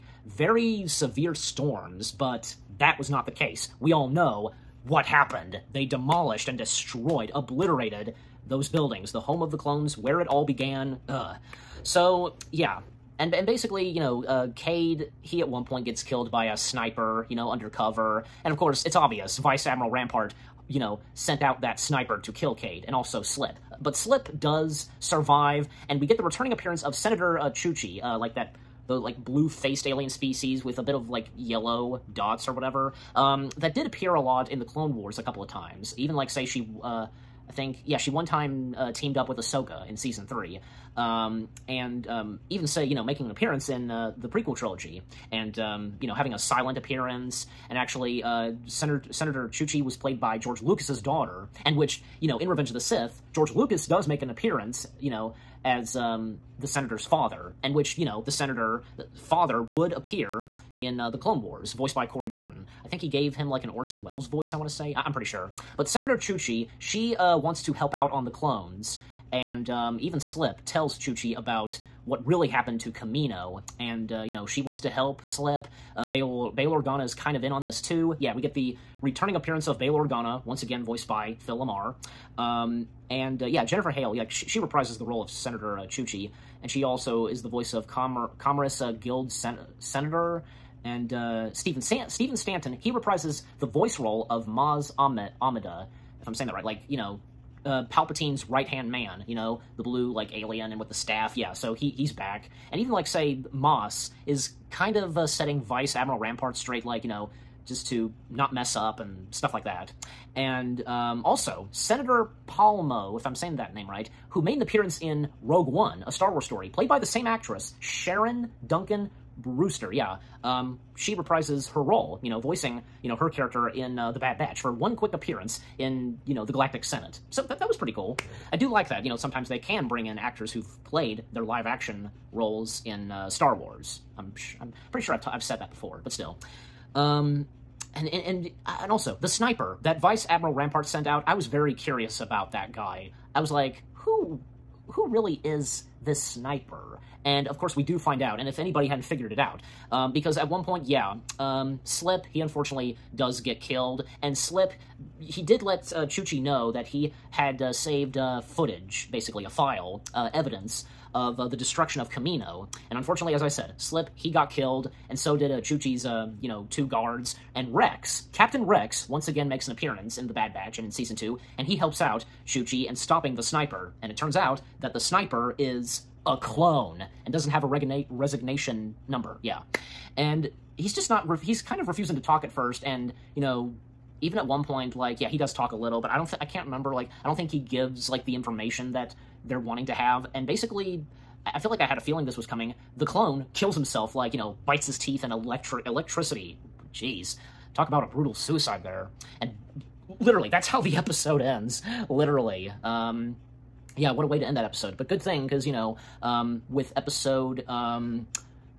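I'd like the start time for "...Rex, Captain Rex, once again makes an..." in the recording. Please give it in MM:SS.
02:47.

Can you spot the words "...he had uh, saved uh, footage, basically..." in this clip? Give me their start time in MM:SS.
02:36.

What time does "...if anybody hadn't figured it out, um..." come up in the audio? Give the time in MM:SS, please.
02:28.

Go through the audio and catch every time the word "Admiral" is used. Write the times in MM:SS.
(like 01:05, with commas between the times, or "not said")
00:19, 01:45, 02:20.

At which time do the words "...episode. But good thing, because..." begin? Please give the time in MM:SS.
03:24.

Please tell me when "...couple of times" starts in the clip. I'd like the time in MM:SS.
00:35.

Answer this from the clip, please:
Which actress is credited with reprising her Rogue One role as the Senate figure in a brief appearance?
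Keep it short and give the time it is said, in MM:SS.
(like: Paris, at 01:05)
Sharon Duncan Brewster, at 01:57.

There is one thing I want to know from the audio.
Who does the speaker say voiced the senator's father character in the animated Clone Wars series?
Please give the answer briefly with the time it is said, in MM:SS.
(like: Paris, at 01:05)
Corey Burton, at 01:02.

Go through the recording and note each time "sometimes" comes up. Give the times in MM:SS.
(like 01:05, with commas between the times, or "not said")
02:09.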